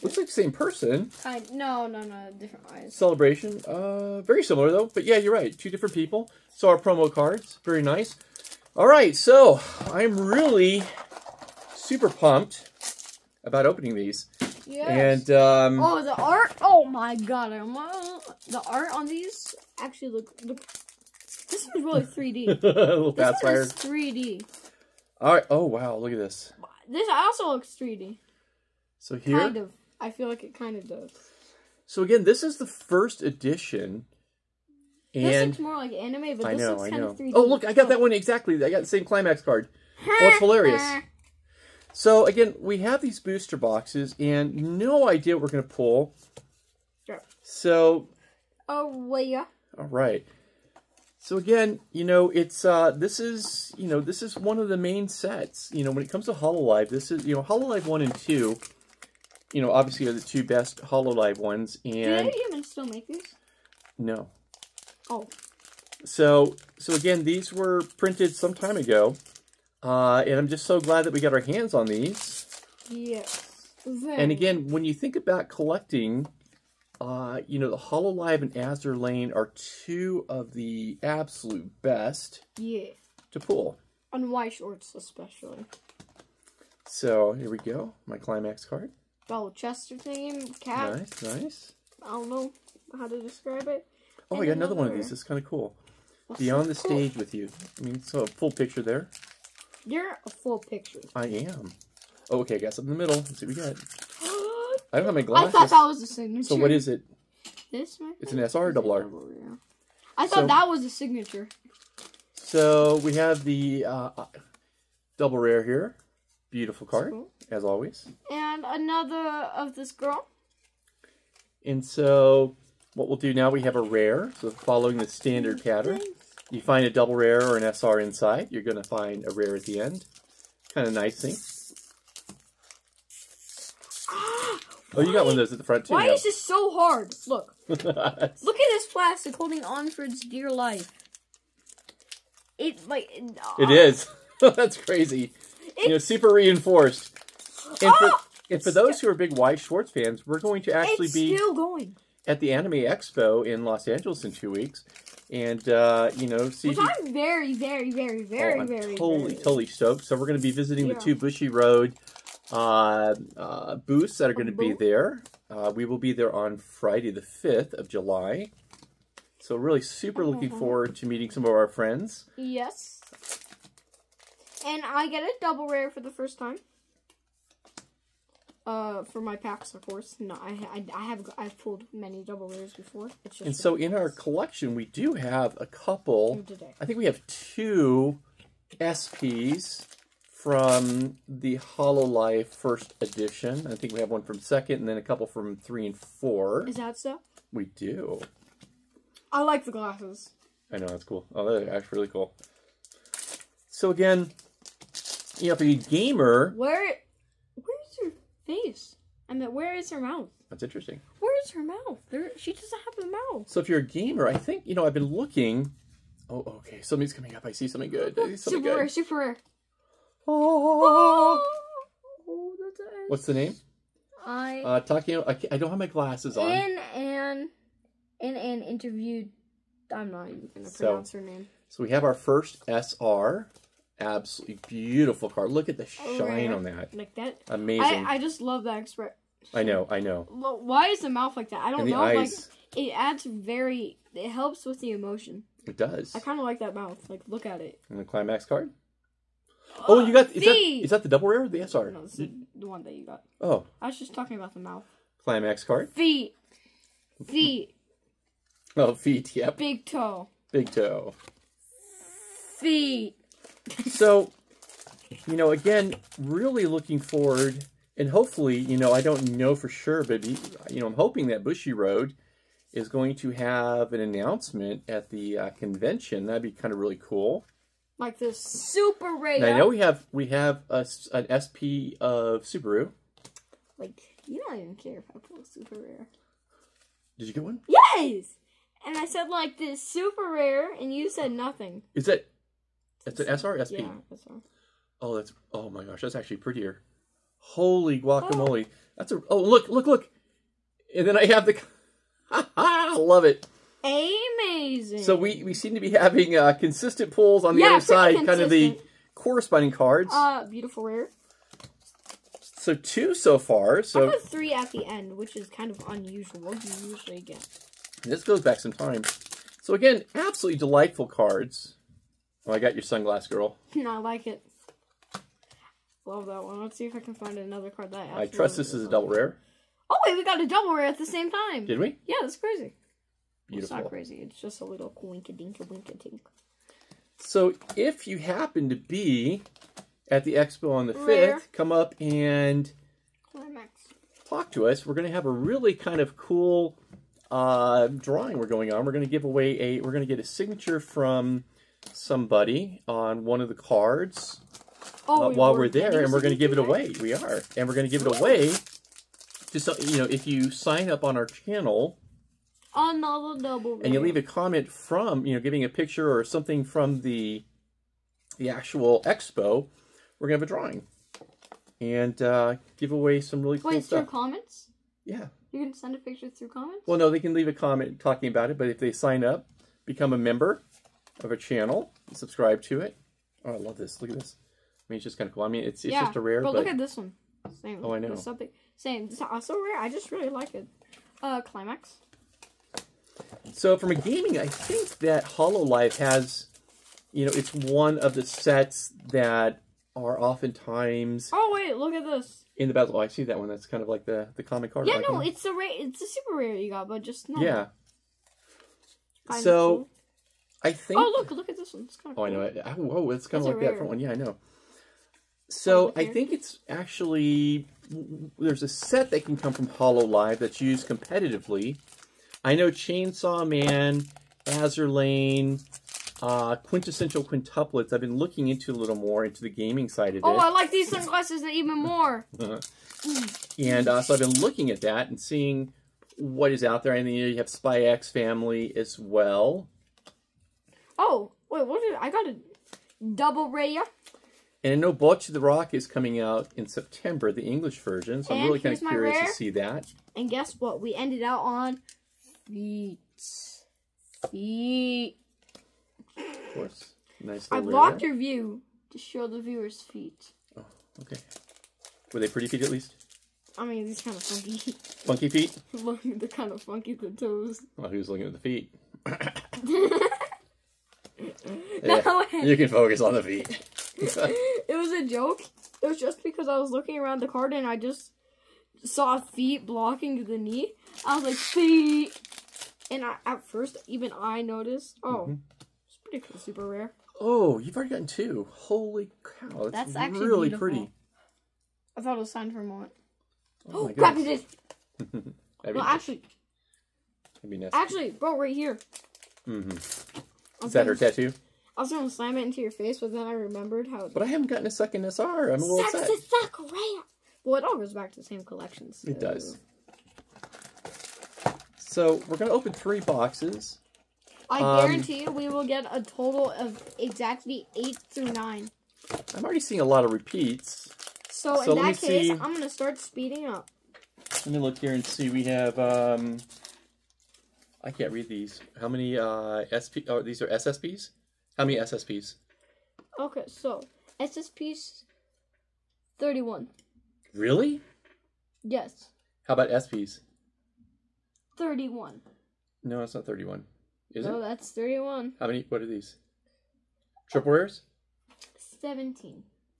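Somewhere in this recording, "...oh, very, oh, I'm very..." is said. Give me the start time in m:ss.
2:38.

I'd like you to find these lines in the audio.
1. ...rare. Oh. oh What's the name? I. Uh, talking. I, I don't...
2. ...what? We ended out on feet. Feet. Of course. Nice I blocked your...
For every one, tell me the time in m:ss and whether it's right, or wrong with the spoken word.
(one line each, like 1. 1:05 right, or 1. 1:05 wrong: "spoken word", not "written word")
1. 3:39 right
2. 7:30 right.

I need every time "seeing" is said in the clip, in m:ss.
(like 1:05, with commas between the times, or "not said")
7:15, 8:39.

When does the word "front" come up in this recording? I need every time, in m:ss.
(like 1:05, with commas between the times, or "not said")
2:15, 6:53.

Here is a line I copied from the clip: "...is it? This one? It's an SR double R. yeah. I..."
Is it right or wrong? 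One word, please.
right.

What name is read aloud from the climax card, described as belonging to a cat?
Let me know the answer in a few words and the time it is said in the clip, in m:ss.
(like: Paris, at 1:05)
Chester, at 1:29.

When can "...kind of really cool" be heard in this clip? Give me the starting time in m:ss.
4:36.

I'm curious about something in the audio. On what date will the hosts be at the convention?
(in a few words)
Friday, July 5.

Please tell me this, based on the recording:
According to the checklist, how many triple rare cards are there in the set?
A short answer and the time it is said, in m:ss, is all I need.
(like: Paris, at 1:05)
17, at 9:08.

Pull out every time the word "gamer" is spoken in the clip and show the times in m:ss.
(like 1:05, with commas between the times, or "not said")
3:25, 3:33.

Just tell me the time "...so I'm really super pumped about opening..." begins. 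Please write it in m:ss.
0:09.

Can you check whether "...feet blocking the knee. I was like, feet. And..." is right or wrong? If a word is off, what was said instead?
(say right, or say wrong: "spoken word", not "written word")
right.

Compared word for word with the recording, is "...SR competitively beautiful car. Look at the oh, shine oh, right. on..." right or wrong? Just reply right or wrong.
wrong.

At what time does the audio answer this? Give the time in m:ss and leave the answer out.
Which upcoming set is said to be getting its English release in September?
7:24.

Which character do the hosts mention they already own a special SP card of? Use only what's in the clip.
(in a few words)
Subaru.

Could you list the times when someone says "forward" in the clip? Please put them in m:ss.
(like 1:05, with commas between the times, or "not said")
2:50, 4:26.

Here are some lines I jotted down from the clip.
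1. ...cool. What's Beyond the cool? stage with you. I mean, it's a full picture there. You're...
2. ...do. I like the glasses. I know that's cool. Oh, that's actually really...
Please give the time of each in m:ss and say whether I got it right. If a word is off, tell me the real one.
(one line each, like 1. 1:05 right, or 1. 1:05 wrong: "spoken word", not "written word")
1. 1:35 right
2. 3:17 right.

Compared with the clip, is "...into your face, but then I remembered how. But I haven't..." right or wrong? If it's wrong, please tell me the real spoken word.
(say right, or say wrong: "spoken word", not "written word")
right.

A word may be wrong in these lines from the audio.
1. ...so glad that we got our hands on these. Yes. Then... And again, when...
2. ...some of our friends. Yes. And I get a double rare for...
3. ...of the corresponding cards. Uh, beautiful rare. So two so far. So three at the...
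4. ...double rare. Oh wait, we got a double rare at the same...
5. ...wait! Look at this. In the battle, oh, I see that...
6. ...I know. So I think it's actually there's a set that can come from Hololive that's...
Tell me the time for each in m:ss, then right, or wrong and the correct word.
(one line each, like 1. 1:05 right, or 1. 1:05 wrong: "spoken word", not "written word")
1. 1:10 right
2. 2:51 right
3. 5:08 right
4. 5:28 right
5. 6:41 right
6. 6:54 right.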